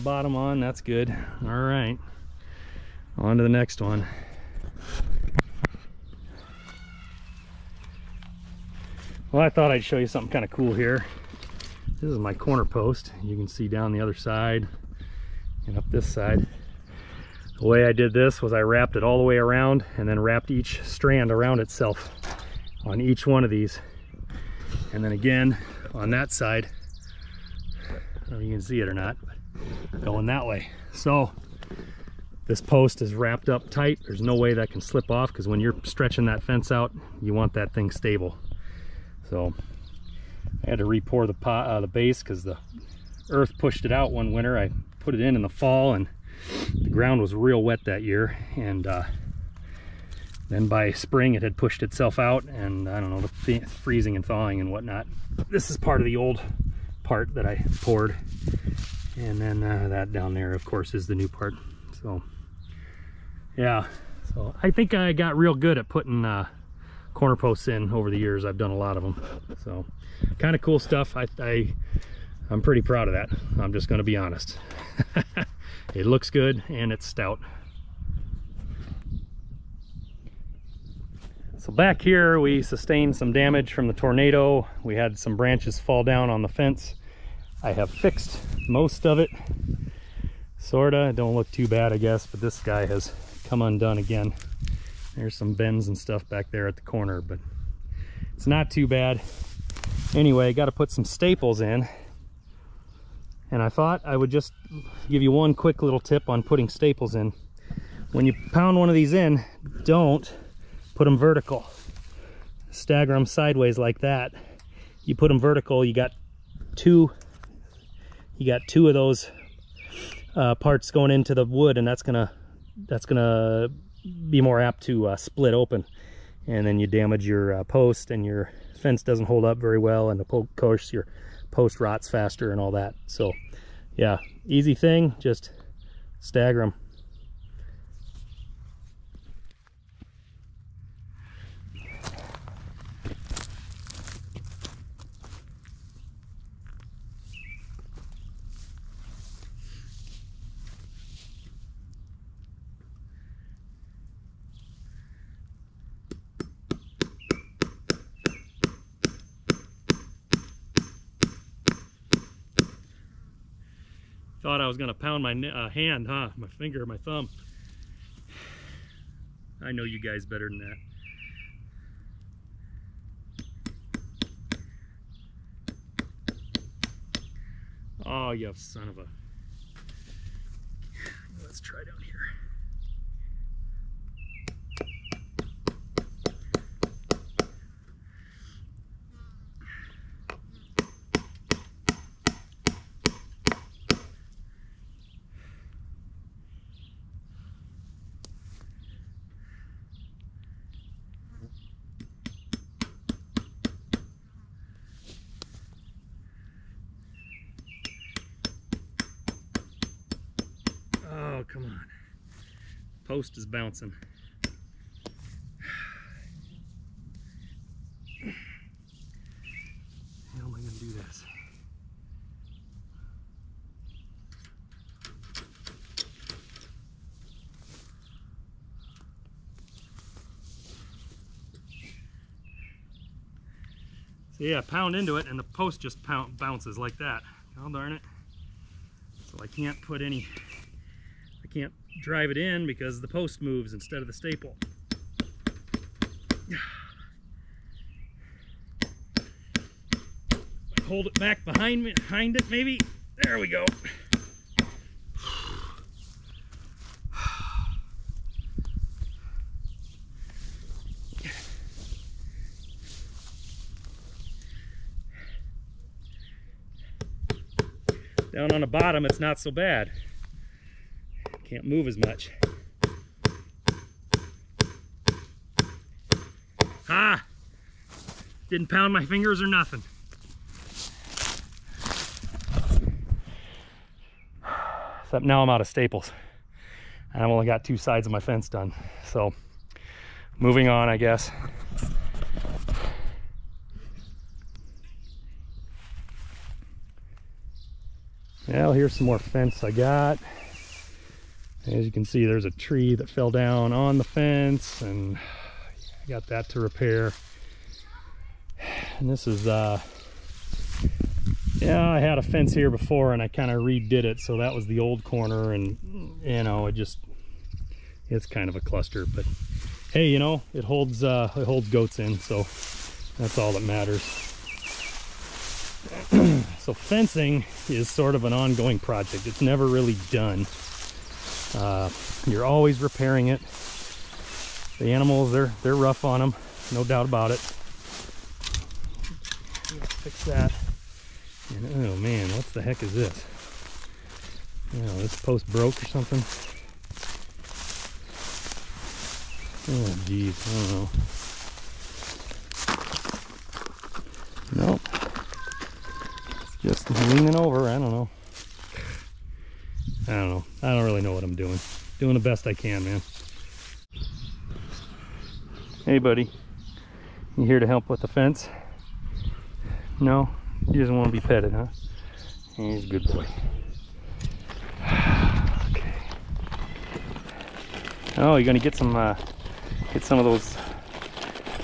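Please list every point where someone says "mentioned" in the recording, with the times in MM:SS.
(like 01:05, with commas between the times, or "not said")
not said.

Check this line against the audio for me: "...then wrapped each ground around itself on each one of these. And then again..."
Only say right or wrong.
wrong.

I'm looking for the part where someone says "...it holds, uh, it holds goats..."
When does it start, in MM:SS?
05:20.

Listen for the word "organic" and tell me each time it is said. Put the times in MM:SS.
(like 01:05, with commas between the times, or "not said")
not said.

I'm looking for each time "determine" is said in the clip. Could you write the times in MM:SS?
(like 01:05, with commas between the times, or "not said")
not said.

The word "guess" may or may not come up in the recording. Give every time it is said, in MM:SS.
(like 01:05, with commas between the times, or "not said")
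01:31, 04:50.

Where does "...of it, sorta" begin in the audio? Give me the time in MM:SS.
01:29.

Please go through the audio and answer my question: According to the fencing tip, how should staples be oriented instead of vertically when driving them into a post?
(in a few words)
Sideways.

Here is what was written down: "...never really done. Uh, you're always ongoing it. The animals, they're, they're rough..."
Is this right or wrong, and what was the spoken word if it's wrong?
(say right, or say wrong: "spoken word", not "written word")
wrong: "repairing", not "ongoing".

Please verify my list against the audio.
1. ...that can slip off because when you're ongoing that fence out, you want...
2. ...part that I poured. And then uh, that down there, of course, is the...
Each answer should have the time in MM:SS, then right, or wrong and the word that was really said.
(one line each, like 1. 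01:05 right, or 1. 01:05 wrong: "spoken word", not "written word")
1. 00:34 wrong: "stretching", not "ongoing"
2. 00:57 right.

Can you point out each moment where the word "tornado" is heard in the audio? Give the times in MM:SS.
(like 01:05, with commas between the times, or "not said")
01:23.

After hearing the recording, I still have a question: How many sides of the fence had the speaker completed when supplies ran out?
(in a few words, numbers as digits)
2.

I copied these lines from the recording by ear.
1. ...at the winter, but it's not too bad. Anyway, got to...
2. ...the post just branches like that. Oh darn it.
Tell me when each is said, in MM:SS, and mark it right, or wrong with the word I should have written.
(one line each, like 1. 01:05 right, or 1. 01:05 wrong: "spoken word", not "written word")
1. 01:36 wrong: "corner", not "winter"
2. 03:55 wrong: "bounces", not "branches".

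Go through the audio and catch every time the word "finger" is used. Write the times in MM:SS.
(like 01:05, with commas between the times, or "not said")
02:46, 04:39.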